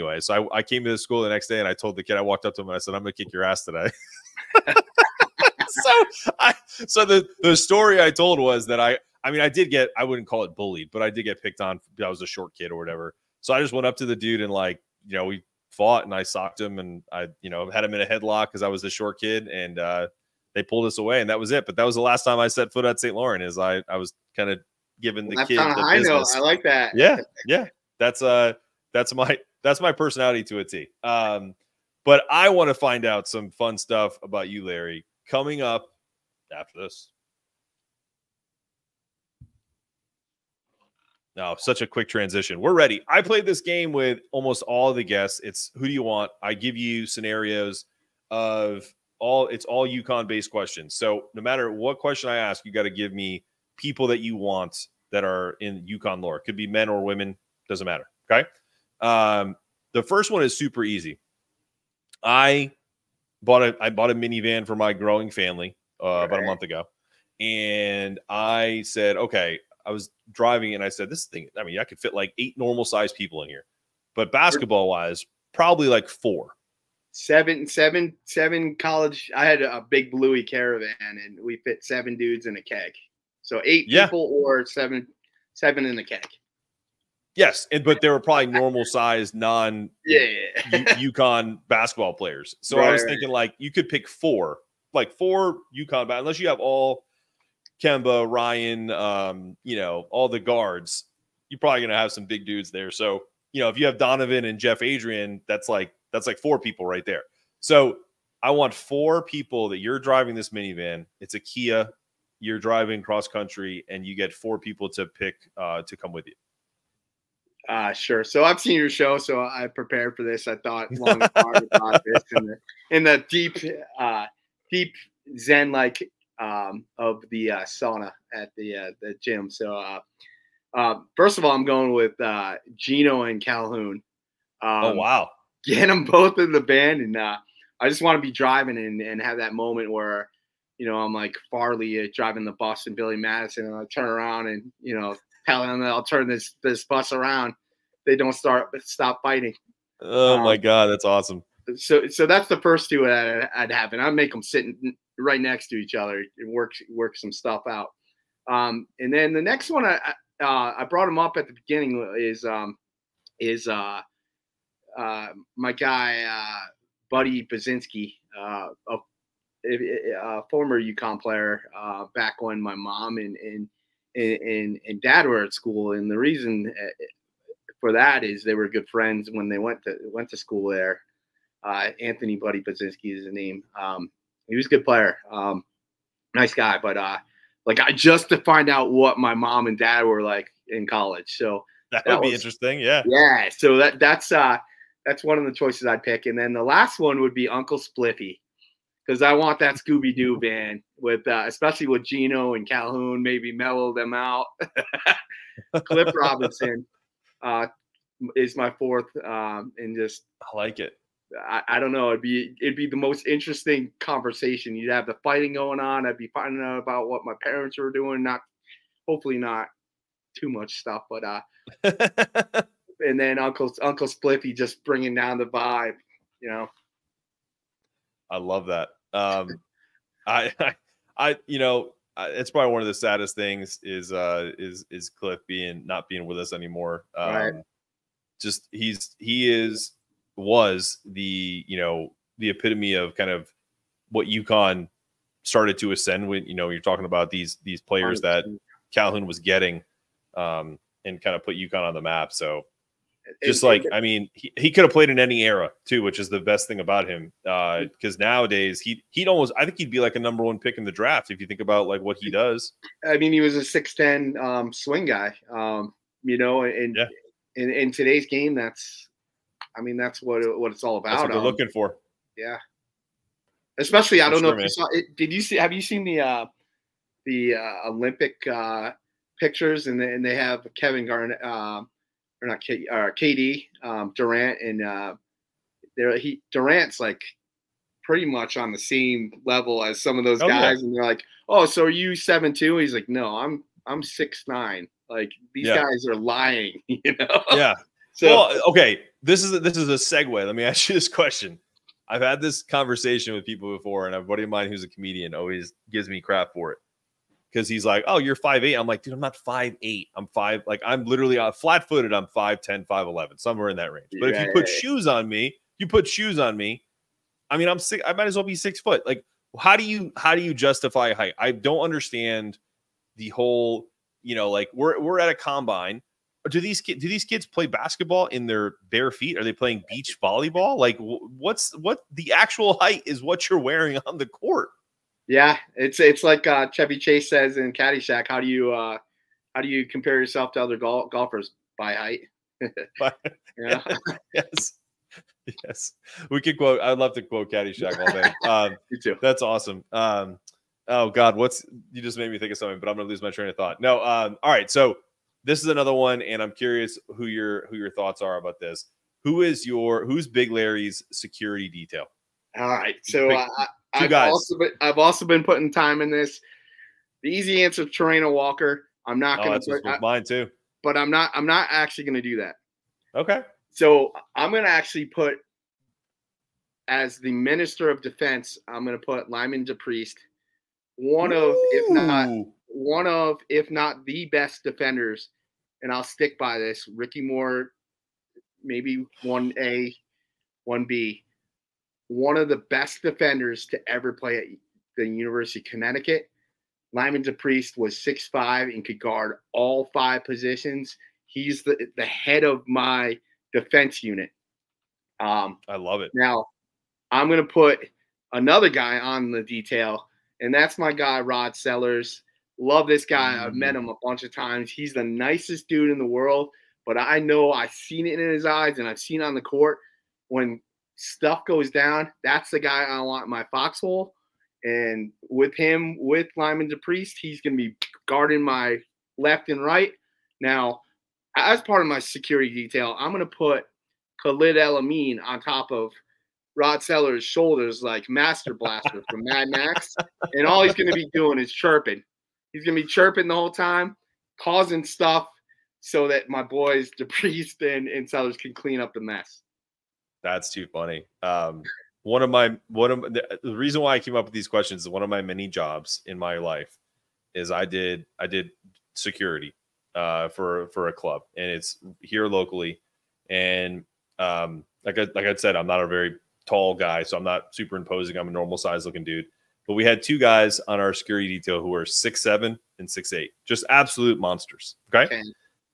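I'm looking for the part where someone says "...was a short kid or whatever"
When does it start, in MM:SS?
00:12.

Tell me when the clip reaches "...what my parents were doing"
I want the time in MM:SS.
03:37.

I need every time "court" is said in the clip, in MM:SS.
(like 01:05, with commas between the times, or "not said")
05:34, 06:59.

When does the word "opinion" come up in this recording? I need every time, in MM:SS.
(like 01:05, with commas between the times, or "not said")
not said.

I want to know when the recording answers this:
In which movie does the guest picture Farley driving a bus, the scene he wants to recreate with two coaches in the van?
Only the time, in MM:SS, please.
02:22.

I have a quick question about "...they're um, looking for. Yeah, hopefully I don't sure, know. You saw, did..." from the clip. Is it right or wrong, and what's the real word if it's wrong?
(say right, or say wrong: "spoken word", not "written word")
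wrong: "especially", not "hopefully".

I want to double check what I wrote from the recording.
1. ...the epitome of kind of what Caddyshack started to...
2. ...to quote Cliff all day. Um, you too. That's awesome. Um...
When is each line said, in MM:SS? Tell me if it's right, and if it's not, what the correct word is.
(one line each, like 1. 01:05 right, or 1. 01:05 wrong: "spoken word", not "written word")
1. 04:02 wrong: "UConn", not "Caddyshack"
2. 05:47 wrong: "Caddyshack", not "Cliff".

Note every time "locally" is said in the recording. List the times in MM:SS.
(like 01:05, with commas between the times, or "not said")
07:42.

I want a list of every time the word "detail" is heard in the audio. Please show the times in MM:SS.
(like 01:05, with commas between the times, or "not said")
06:01, 06:49, 07:12, 07:51.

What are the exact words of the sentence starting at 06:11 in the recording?
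I'm not actually going to do that.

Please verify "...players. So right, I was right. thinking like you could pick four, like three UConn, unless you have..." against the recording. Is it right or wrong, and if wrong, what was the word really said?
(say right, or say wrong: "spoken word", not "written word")
wrong: "four", not "three".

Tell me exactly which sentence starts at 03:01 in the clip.
Uh, Anthony Buddy Pazinski is his name.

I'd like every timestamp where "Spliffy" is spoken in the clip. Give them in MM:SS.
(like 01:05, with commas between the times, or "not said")
03:17, 03:44.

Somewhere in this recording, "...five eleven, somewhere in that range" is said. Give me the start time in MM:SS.
05:12.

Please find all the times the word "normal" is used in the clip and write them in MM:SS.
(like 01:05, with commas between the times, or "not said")
01:12, 01:28, 07:48.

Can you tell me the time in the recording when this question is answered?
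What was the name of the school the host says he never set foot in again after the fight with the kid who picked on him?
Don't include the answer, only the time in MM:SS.
00:22.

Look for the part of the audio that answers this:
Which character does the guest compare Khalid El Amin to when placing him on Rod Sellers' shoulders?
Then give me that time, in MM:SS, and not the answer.
07:18.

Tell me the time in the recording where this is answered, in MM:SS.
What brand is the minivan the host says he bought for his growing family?
01:51.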